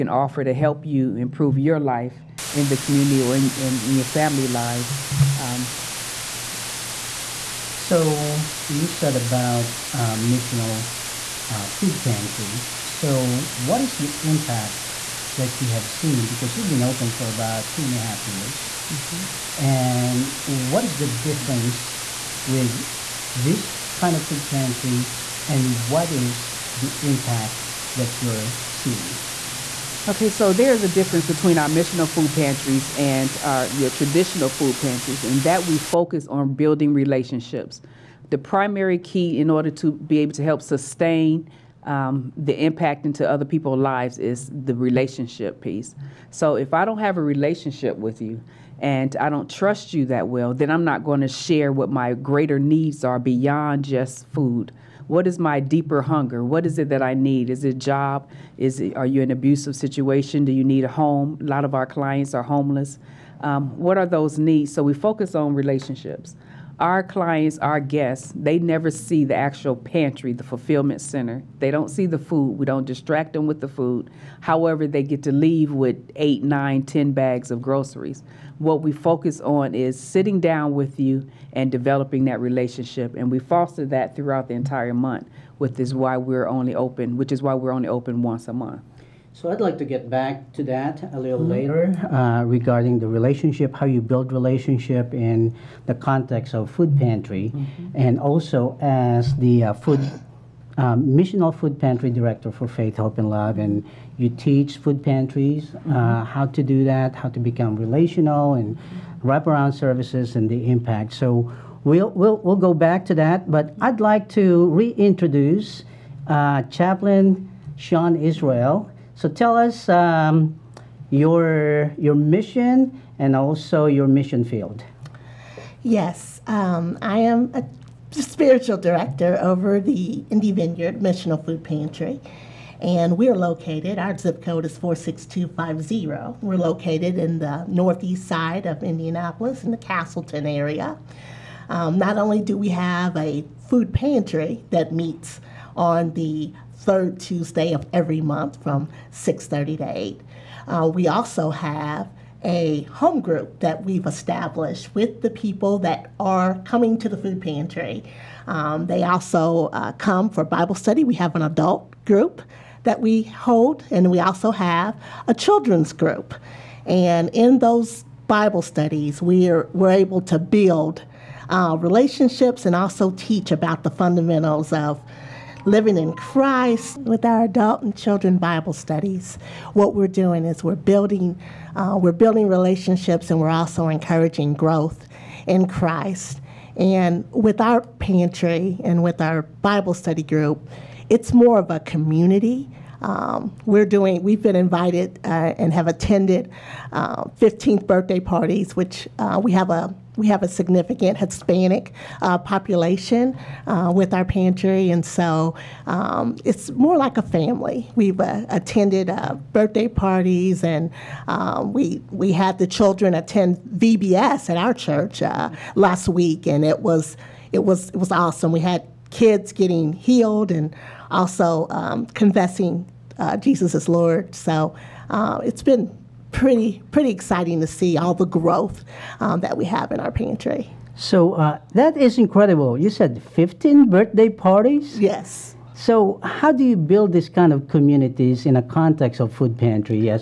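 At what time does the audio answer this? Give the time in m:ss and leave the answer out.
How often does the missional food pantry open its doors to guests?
1:28.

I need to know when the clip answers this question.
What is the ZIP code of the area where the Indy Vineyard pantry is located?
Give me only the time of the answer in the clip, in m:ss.
2:14.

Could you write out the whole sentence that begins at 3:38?
We had kids getting healed and also um, confessing uh, Jesus as Lord.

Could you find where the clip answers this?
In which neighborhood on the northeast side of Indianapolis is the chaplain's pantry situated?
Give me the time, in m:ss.
2:19.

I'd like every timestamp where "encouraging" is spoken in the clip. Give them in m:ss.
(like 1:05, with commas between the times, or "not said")
3:03.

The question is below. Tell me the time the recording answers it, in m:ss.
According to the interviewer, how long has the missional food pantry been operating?
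0:17.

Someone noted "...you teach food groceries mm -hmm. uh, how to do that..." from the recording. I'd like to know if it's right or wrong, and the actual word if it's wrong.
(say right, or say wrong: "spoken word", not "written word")
wrong: "pantries", not "groceries".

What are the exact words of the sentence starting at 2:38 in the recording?
Um, they also uh, come for Bible study.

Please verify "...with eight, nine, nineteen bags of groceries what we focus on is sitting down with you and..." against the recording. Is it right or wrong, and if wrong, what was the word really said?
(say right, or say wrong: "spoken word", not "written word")
wrong: "ten", not "nineteen".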